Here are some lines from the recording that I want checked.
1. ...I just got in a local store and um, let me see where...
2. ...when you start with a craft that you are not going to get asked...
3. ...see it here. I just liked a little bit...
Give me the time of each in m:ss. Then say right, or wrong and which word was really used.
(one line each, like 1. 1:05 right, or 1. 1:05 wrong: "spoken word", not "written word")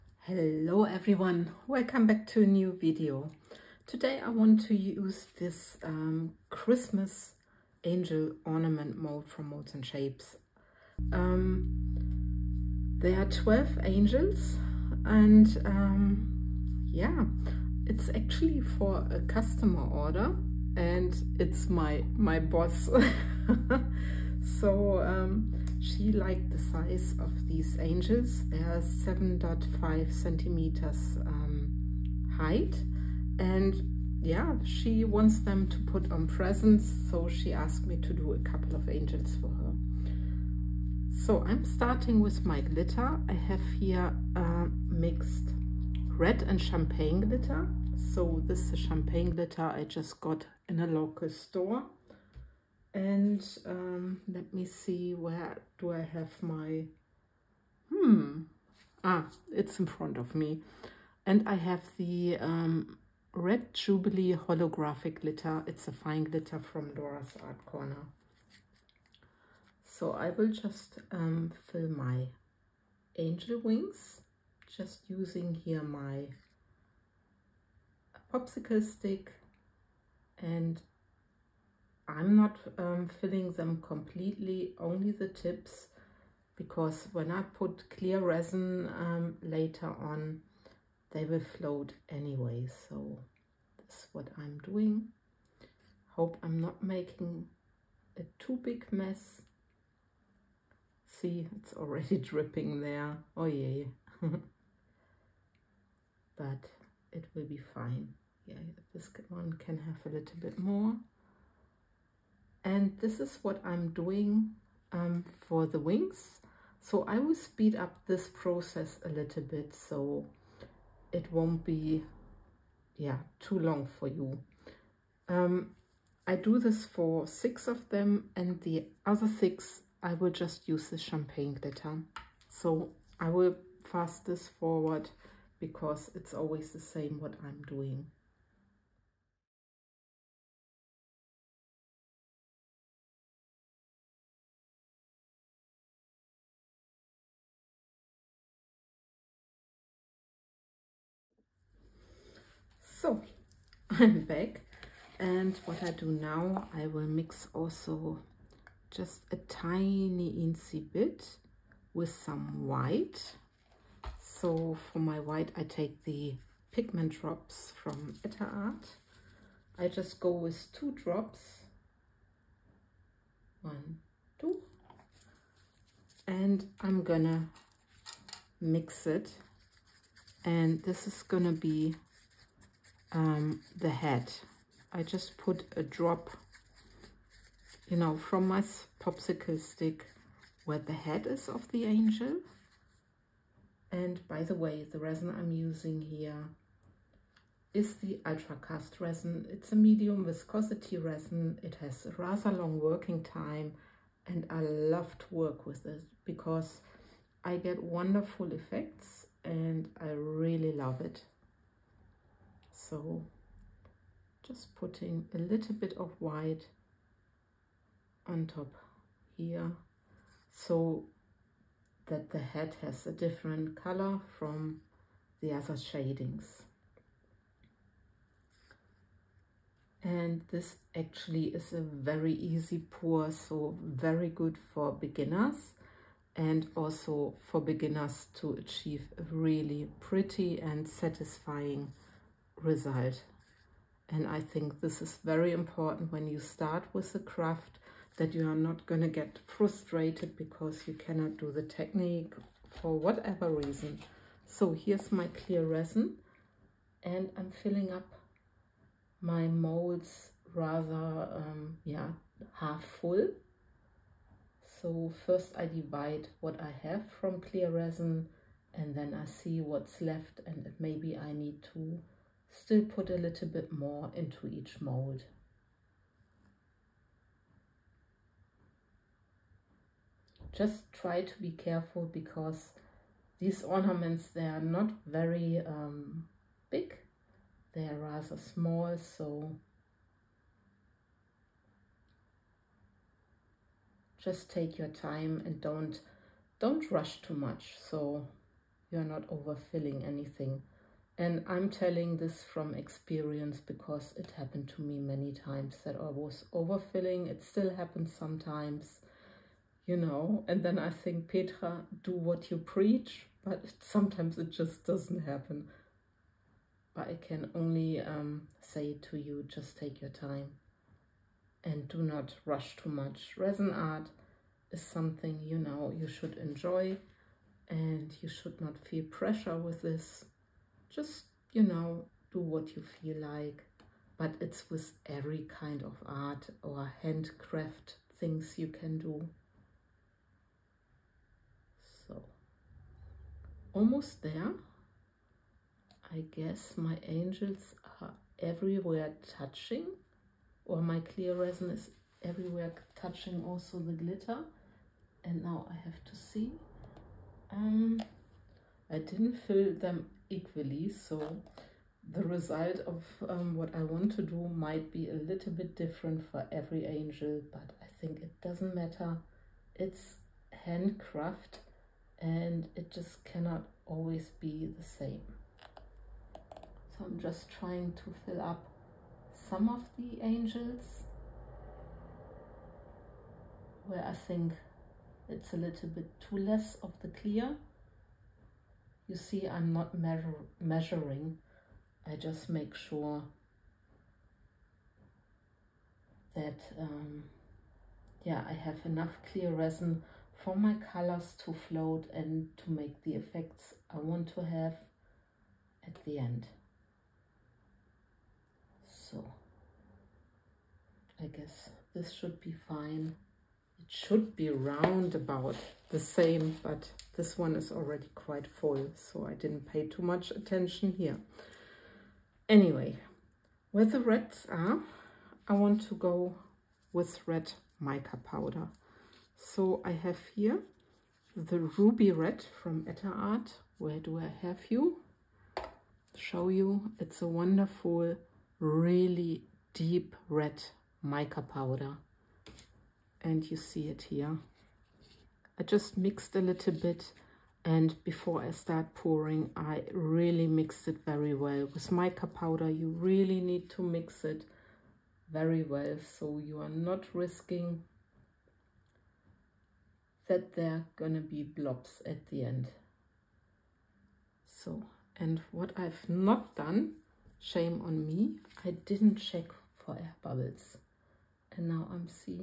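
1. 0:49 right
2. 4:06 wrong: "frustrated", not "asked"
3. 7:23 wrong: "mixed", not "liked".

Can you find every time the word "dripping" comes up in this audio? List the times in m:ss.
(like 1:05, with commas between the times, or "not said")
1:42.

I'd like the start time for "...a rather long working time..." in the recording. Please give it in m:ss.
3:22.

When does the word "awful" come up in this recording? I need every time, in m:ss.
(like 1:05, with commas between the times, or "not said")
not said.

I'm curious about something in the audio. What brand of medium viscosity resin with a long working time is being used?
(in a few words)
Ultra Cast.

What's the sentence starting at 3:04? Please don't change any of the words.
I just put a drop, you know, from my popsicle stick where the head is of the angel.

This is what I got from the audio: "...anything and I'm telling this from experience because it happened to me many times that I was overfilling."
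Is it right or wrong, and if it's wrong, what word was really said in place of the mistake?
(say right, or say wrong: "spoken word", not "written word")
right.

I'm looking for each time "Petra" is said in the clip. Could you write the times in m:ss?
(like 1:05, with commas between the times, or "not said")
5:11.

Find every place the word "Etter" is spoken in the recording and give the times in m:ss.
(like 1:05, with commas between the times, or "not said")
2:48, 7:12.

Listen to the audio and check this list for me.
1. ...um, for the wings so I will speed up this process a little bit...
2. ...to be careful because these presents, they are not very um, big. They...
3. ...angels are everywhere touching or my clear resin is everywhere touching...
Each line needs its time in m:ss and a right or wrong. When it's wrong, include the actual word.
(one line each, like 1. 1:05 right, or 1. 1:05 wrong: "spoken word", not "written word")
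1. 1:54 right
2. 4:41 wrong: "ornaments", not "presents"
3. 5:47 right.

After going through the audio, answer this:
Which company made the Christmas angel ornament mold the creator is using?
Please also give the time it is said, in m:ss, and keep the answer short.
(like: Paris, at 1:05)
Molds and Shapes, at 0:09.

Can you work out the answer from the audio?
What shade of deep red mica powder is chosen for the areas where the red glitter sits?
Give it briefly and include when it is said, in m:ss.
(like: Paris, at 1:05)
ruby red, at 7:11.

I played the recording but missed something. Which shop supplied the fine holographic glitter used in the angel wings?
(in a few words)
Dora's Art Corner.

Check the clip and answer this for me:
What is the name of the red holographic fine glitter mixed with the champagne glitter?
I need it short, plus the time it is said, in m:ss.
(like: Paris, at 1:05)
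Red Jubilee, at 1:03.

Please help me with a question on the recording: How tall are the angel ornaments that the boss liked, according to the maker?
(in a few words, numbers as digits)
7.5 centimeters.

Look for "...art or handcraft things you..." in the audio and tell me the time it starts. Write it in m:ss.
5:36.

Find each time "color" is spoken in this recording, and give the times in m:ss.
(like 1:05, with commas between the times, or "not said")
3:43, 6:40.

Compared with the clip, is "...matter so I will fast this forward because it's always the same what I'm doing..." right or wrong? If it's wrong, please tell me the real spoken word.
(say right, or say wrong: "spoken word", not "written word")
wrong: "glitter", not "matter".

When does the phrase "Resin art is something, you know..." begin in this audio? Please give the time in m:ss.
5:23.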